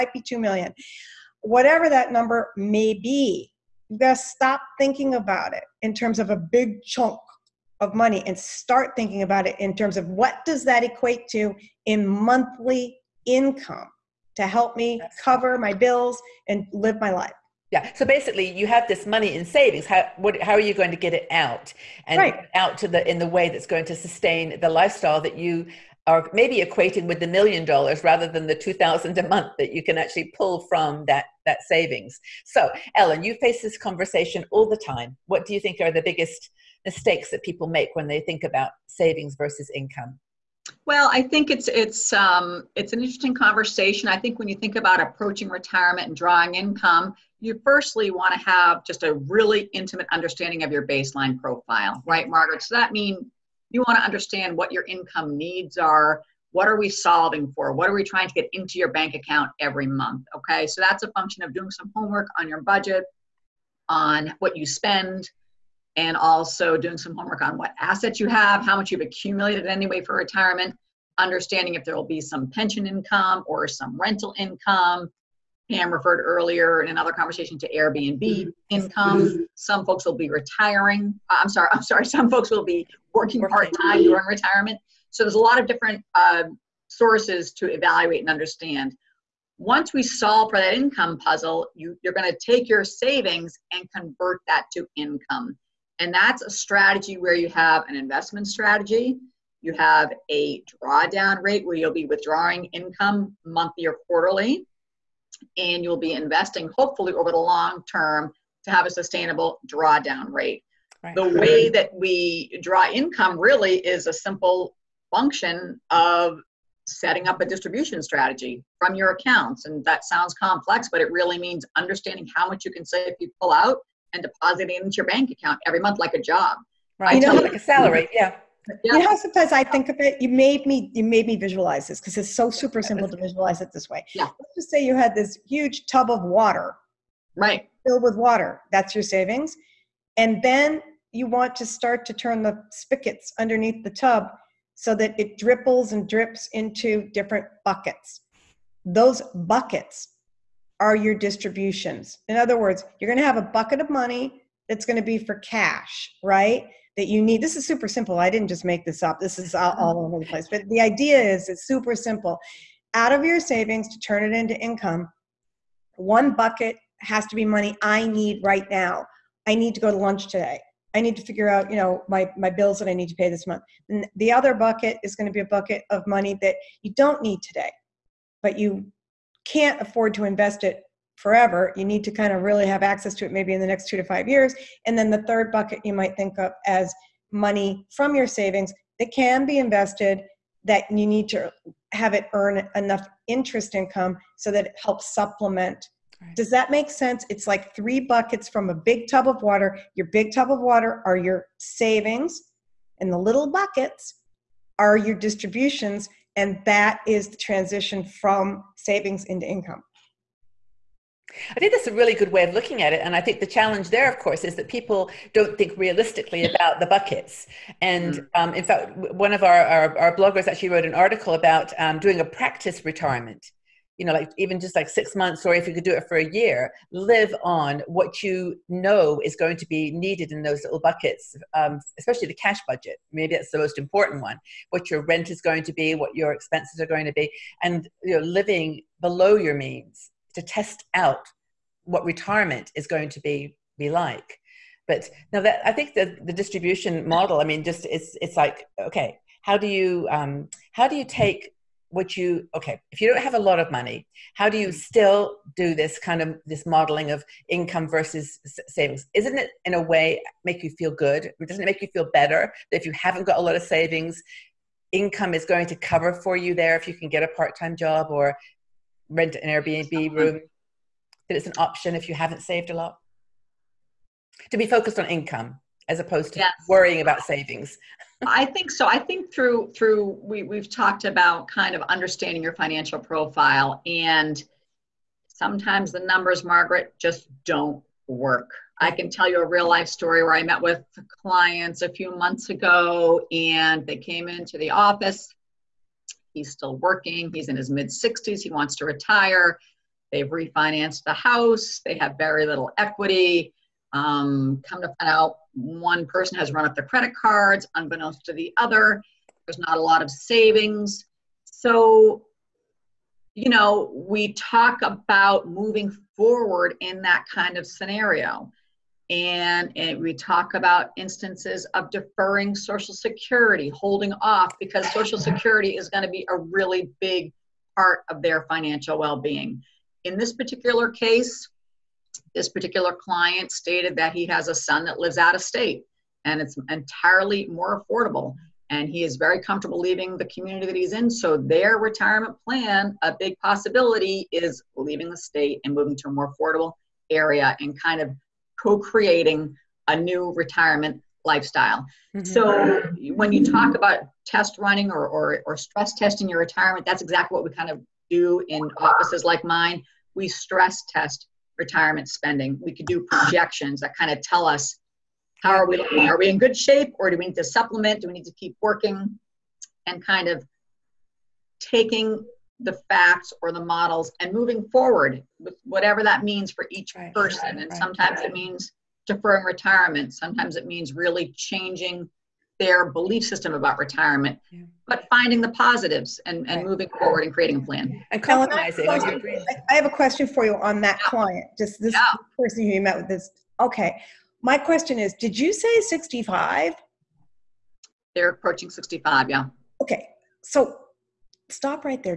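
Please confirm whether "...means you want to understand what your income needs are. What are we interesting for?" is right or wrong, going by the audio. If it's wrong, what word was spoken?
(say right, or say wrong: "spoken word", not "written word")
wrong: "solving", not "interesting".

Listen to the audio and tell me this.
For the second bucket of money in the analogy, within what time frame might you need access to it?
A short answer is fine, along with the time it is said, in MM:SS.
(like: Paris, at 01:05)
2 to 5 years, at 03:03.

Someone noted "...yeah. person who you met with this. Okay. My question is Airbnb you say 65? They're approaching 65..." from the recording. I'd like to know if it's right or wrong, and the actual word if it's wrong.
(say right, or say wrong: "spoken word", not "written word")
wrong: "Did", not "Airbnb".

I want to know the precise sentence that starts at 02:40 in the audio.
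But the idea is it's super simple.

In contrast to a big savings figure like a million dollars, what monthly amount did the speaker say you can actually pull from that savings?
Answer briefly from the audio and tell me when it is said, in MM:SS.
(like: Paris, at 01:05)
2,000 a month, at 00:28.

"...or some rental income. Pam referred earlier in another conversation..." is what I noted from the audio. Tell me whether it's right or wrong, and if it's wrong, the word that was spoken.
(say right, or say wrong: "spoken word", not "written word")
right.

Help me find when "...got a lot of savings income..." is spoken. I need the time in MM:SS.
04:23.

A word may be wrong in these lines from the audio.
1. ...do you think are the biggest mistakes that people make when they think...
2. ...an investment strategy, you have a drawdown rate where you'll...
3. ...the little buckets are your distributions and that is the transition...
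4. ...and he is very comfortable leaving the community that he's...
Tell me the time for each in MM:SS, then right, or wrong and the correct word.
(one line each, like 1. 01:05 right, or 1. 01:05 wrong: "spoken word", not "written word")
1. 00:35 right
2. 01:37 right
3. 03:23 right
4. 05:38 right.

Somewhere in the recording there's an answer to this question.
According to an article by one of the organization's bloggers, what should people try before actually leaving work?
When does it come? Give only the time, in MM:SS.
03:42.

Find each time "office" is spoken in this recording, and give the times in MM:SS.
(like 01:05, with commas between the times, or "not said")
04:54, 05:58.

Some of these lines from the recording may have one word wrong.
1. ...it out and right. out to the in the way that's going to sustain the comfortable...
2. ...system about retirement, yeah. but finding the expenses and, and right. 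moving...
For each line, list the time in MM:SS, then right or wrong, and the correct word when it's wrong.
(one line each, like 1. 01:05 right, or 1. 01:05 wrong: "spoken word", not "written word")
1. 00:21 wrong: "lifestyle", not "comfortable"
2. 06:23 wrong: "positives", not "expenses".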